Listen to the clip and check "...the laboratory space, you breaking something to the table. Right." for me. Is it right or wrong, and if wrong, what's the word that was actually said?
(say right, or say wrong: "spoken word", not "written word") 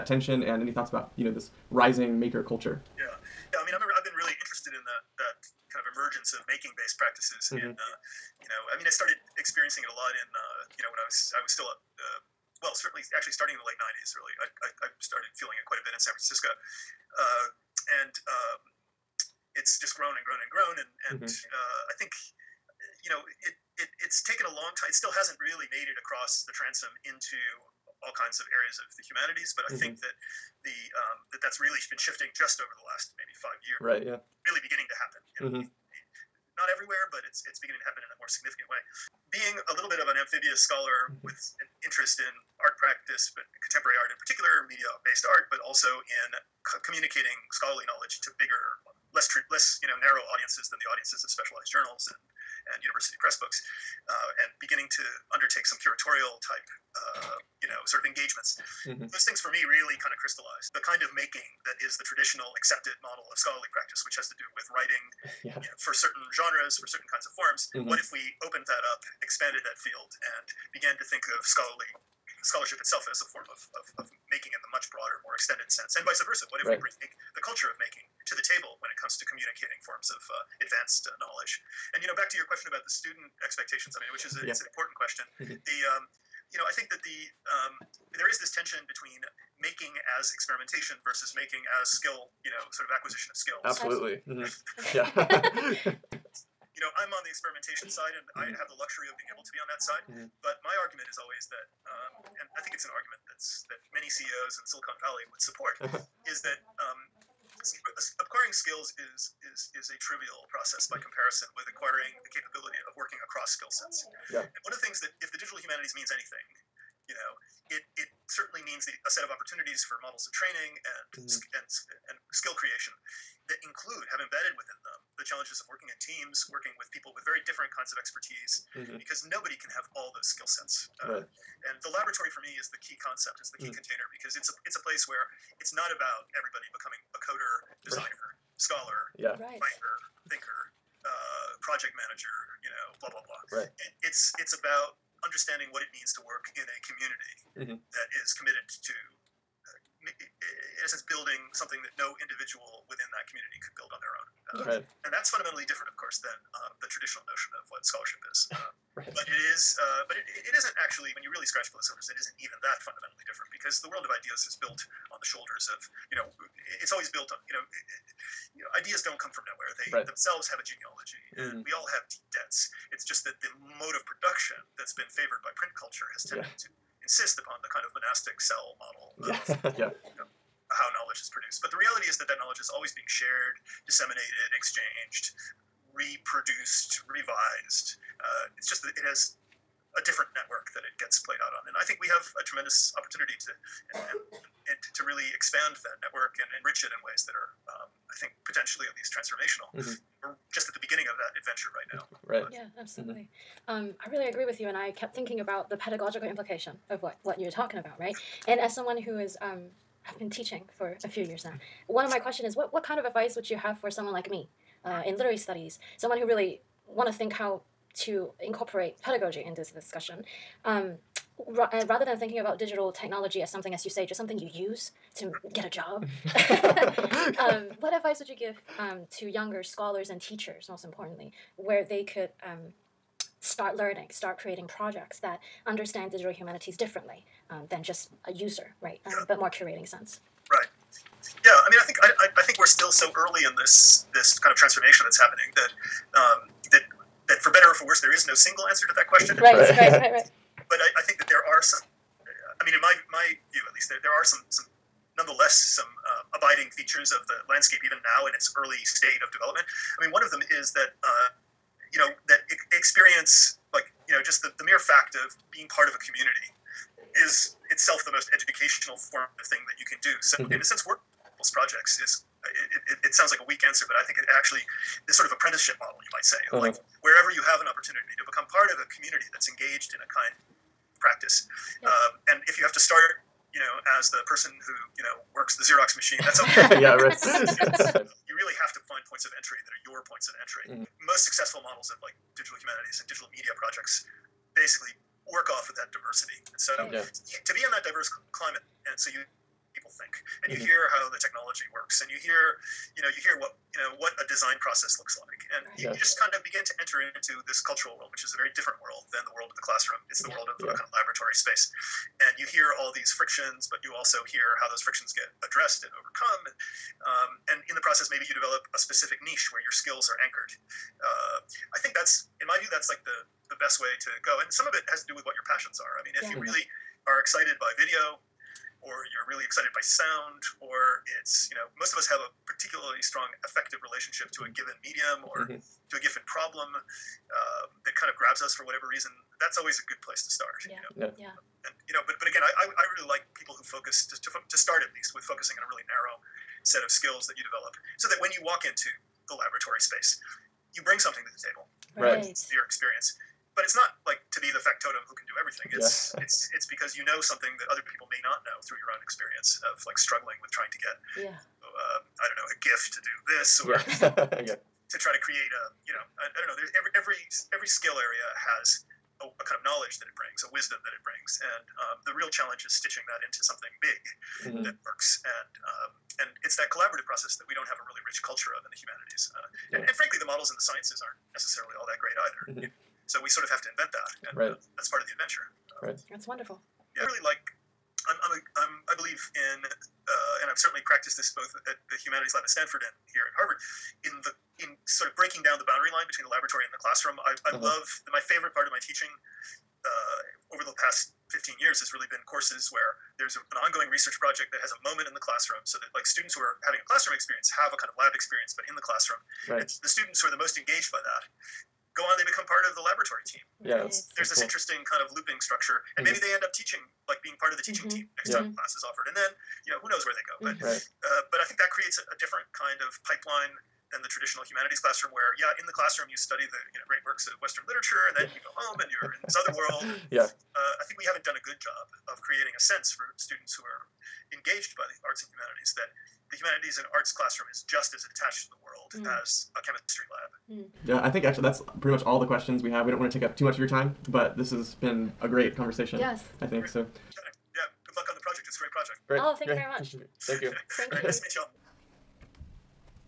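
wrong: "bring", not "breaking".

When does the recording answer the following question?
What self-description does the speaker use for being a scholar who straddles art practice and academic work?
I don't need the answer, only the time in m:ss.
0:40.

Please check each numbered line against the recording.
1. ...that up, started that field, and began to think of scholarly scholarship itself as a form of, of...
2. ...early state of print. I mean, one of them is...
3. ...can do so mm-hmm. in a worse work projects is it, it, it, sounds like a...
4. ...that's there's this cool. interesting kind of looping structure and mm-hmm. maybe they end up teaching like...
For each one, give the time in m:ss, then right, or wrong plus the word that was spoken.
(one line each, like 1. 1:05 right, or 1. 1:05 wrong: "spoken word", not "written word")
1. 1:08 wrong: "expanded", not "started"
2. 4:18 wrong: "development", not "print"
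3. 4:29 wrong: "sense", not "worse"
4. 6:54 right.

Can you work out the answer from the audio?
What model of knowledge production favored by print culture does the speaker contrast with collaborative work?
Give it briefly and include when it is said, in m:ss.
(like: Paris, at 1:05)
monastic cell model, at 2:57.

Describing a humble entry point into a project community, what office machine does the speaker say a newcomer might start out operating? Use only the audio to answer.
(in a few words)
Xerox machine.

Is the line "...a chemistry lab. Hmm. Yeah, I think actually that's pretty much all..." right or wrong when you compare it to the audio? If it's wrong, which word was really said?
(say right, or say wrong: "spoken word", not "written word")
right.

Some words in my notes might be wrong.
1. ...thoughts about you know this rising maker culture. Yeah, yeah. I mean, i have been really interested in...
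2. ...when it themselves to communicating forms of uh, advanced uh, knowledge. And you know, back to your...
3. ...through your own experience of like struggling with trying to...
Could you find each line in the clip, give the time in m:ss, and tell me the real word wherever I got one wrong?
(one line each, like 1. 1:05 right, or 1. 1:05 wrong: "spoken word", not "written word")
1. 0:00 right
2. 1:18 wrong: "comes", not "themselves"
3. 5:58 right.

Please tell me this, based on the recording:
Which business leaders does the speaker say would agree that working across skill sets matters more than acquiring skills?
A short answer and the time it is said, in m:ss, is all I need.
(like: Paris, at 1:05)
CEOs in Silicon Valley, at 1:44.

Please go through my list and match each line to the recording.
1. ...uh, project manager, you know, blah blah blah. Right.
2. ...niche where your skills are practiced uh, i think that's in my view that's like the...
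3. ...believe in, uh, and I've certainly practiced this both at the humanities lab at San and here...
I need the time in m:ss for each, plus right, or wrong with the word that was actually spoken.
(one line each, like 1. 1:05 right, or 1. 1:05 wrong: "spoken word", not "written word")
1. 2:21 right
2. 5:19 wrong: "anchored", not "practiced"
3. 6:28 wrong: "Stanford", not "San".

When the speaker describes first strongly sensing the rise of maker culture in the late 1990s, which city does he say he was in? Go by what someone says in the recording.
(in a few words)
San Francisco.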